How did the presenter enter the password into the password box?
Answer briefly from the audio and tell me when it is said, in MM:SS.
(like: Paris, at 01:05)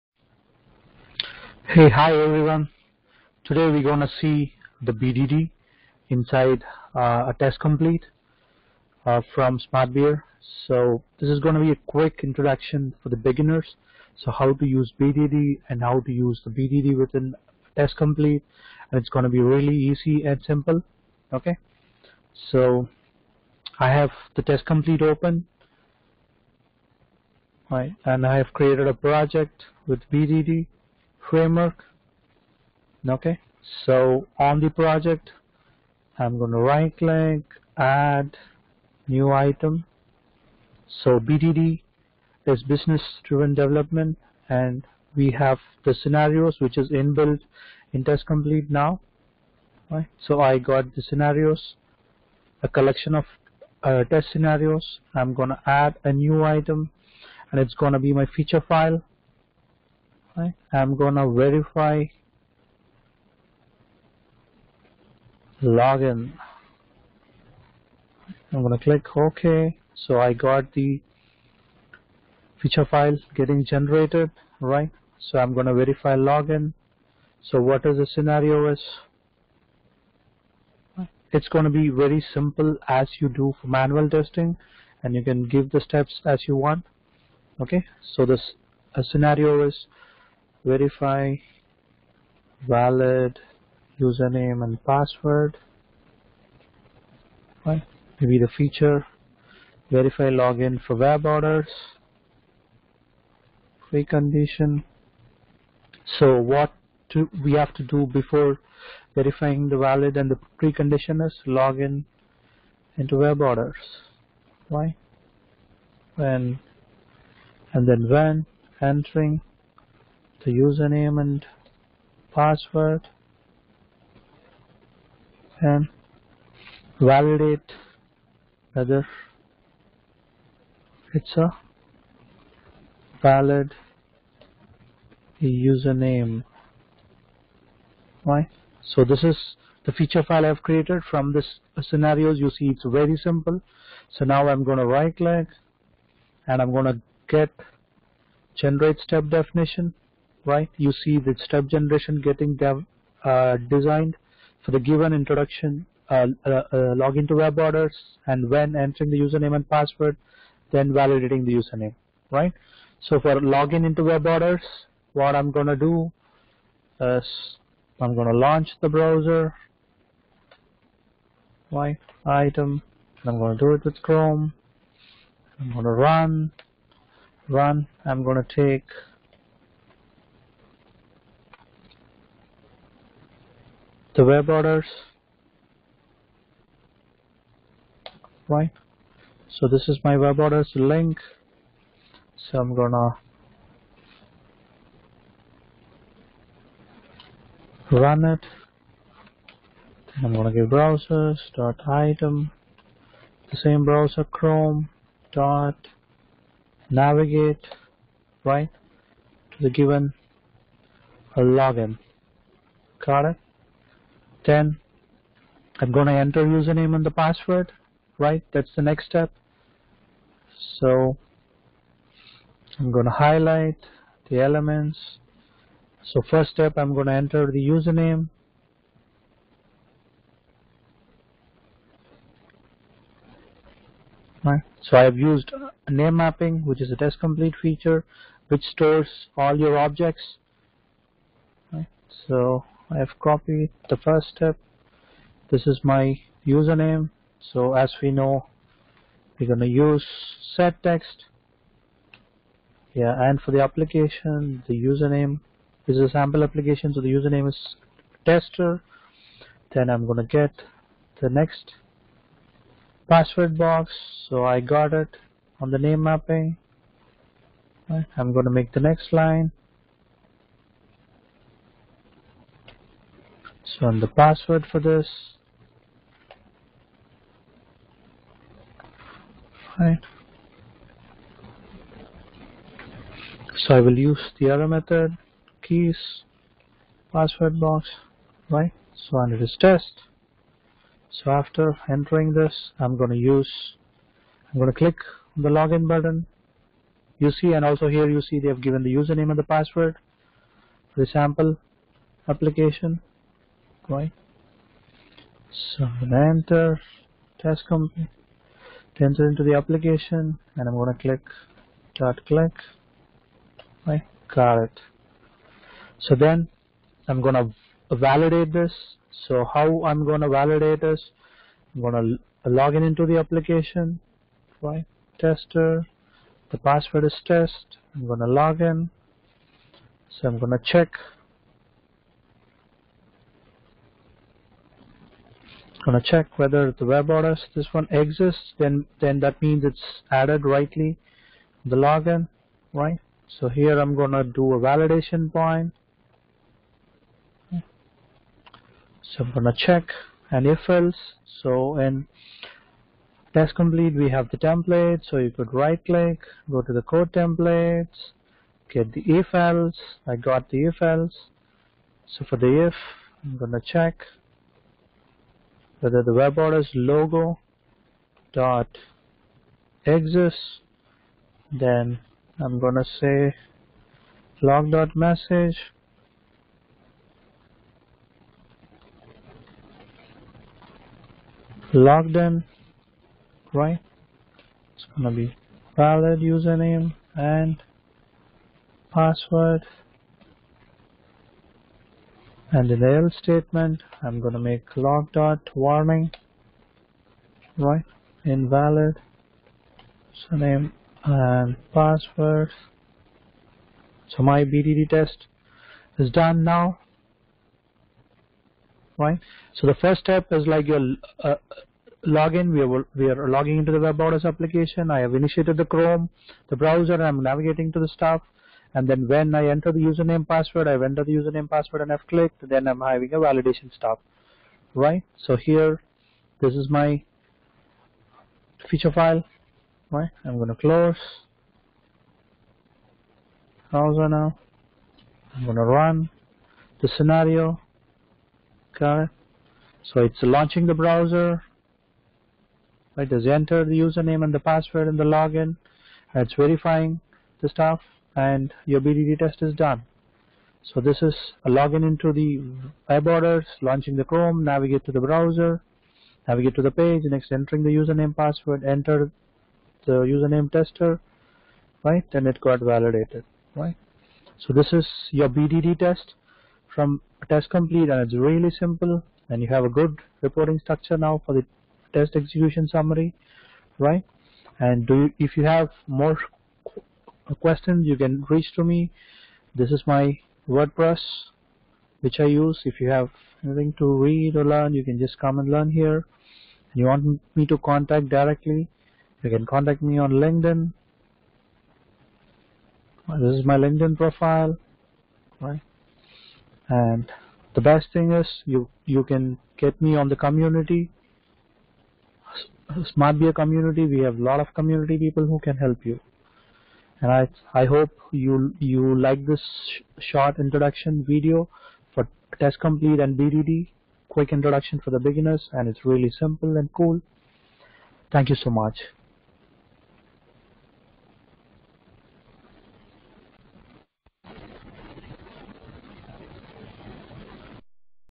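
Keys, at 04:45.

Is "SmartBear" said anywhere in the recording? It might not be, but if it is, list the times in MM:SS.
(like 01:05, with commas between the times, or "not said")
00:09, 08:22.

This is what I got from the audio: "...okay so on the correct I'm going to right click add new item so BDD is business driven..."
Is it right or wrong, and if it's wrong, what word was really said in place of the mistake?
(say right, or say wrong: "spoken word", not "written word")
wrong: "project", not "correct".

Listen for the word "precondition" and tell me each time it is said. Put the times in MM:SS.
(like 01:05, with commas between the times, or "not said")
01:43, 01:50.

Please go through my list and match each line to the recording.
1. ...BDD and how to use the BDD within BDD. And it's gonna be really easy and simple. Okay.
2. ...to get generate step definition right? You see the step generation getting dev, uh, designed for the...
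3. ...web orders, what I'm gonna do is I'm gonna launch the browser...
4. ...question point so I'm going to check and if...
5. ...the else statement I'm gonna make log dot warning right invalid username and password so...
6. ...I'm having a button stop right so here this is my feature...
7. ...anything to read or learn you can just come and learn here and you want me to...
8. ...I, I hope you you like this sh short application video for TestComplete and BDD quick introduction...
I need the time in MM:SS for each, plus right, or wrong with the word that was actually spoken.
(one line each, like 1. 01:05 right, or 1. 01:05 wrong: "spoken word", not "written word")
1. 00:14 wrong: "TestComplete", not "BDD"
2. 02:26 right
3. 02:44 right
4. 05:44 wrong: "validation", not "question"
5. 06:32 right
6. 07:02 wrong: "validation", not "button"
7. 08:03 right
8. 08:27 wrong: "introduction", not "application".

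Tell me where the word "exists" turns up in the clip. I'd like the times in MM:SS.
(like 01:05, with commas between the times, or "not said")
05:37, 06:09.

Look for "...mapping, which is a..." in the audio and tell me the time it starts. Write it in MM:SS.
03:56.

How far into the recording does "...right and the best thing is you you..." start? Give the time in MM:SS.
08:15.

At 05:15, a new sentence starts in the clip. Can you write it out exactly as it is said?
So then I'm gonna validate this.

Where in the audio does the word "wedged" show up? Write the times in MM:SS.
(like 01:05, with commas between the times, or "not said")
not said.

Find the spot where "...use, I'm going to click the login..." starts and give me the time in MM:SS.
04:53.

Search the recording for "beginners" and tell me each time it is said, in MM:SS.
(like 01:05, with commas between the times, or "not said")
00:13, 08:34.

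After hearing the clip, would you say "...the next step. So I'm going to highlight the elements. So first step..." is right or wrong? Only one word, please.
right.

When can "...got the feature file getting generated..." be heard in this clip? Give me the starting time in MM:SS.
01:10.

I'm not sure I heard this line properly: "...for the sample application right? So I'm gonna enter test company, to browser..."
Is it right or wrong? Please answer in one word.
wrong.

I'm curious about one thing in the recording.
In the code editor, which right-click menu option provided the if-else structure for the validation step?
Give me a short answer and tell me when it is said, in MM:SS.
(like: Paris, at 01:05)
code templates, at 05:56.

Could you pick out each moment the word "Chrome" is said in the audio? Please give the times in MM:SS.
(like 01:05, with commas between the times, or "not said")
02:54, 03:24, 06:55, 07:34.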